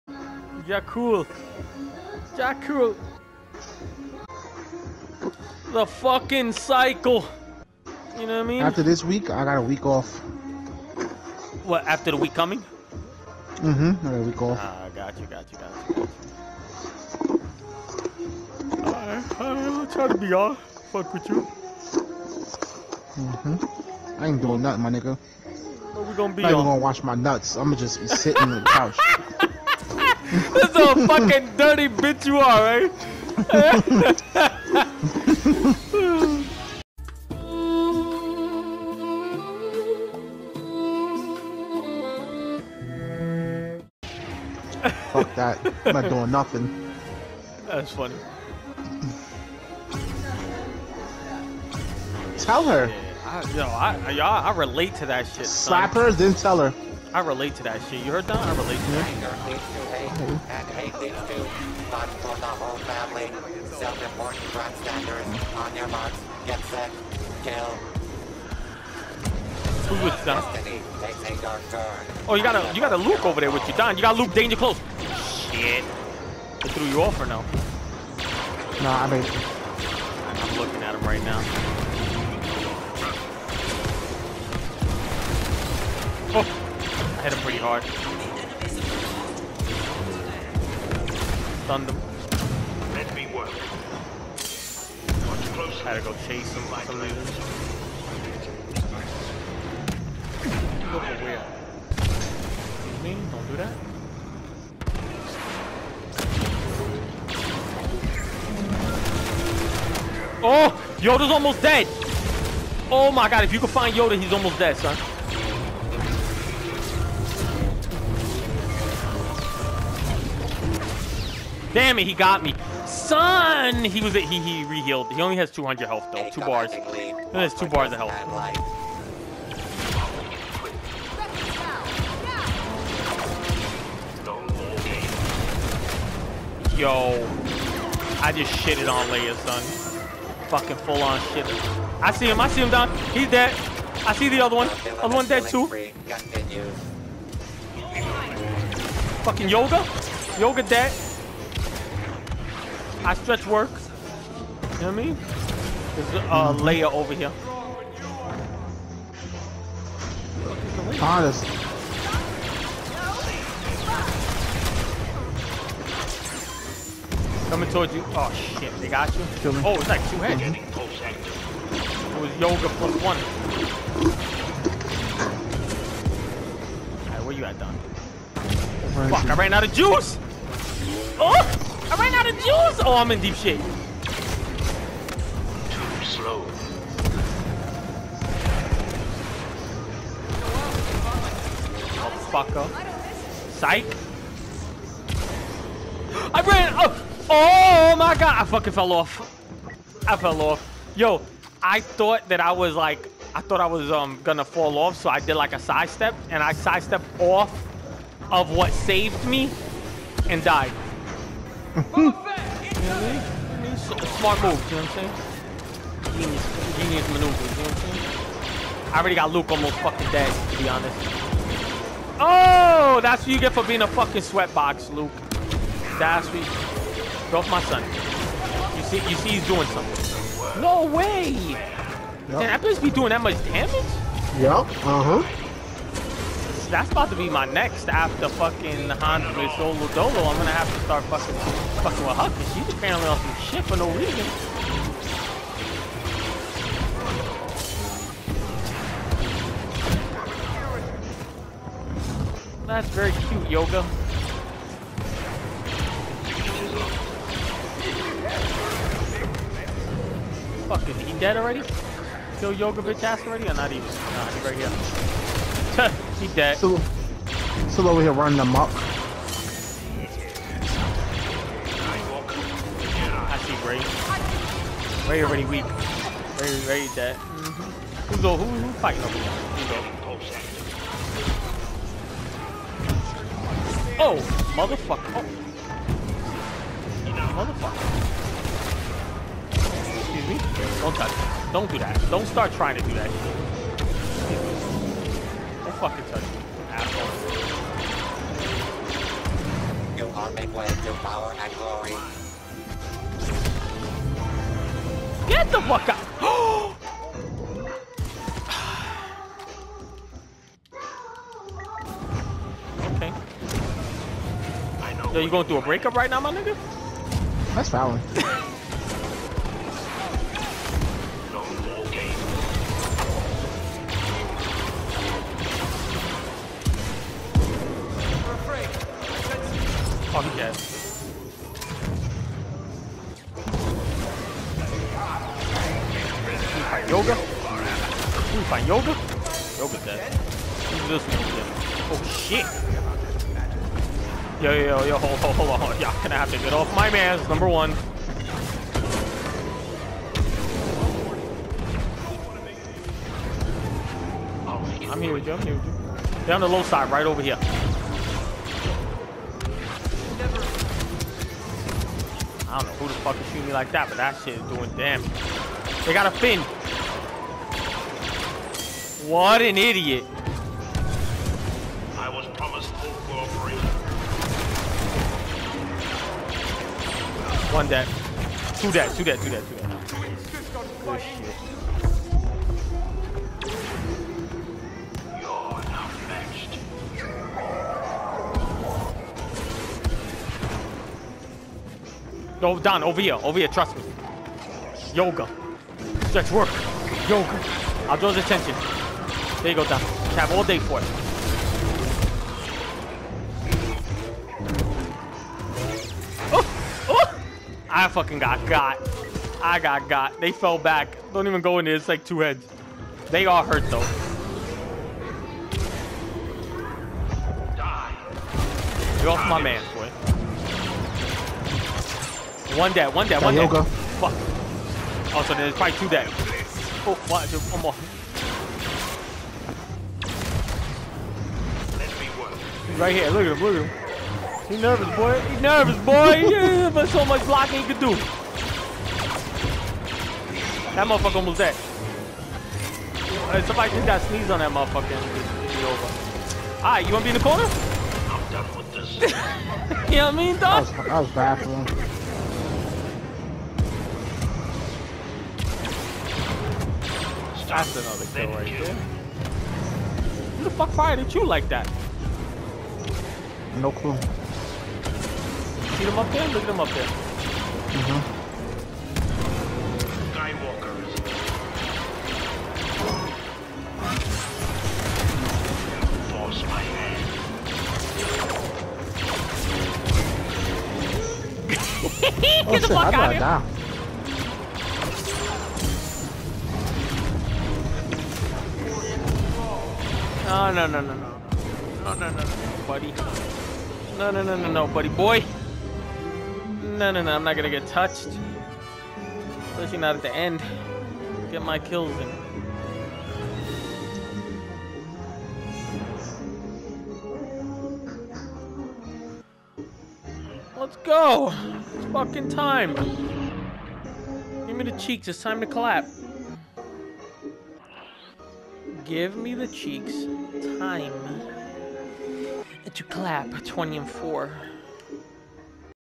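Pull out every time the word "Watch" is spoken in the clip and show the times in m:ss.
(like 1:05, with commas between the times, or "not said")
1:35.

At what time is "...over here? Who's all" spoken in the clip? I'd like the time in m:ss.
4:39.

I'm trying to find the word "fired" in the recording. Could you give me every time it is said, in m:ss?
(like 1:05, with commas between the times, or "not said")
7:40.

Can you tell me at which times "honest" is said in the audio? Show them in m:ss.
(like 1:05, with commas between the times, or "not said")
2:41, 3:40.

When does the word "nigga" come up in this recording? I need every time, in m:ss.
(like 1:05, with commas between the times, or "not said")
0:24, 5:16.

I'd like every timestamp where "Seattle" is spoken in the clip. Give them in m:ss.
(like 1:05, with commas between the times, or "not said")
not said.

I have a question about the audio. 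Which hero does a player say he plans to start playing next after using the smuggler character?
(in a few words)
Huck.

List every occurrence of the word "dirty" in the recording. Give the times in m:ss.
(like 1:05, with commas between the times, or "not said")
0:31.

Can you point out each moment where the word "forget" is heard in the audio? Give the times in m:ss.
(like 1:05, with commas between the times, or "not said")
not said.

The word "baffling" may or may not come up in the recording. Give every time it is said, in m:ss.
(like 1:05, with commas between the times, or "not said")
7:31.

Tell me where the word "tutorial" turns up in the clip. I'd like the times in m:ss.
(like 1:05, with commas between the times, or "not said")
not said.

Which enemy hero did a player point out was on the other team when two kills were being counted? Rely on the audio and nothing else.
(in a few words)
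Finn.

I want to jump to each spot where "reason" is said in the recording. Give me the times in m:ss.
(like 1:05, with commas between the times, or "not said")
1:36, 4:03.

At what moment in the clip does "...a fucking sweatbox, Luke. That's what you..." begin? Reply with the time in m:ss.
3:43.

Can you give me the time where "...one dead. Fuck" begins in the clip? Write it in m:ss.
7:03.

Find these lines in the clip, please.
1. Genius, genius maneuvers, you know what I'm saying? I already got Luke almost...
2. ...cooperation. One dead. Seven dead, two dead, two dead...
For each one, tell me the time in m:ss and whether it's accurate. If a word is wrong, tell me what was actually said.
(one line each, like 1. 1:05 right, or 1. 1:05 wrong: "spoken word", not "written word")
1. 3:36 right
2. 6:13 wrong: "Two", not "Seven".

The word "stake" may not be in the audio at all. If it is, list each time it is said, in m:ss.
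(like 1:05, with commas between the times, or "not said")
not said.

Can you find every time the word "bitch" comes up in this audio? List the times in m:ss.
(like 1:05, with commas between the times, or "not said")
0:31, 4:22.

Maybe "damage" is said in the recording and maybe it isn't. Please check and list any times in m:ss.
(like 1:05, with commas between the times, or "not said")
3:53, 6:04.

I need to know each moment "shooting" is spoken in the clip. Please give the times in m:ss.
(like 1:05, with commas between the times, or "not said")
6:03.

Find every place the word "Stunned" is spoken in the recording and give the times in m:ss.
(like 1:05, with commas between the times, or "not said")
1:27.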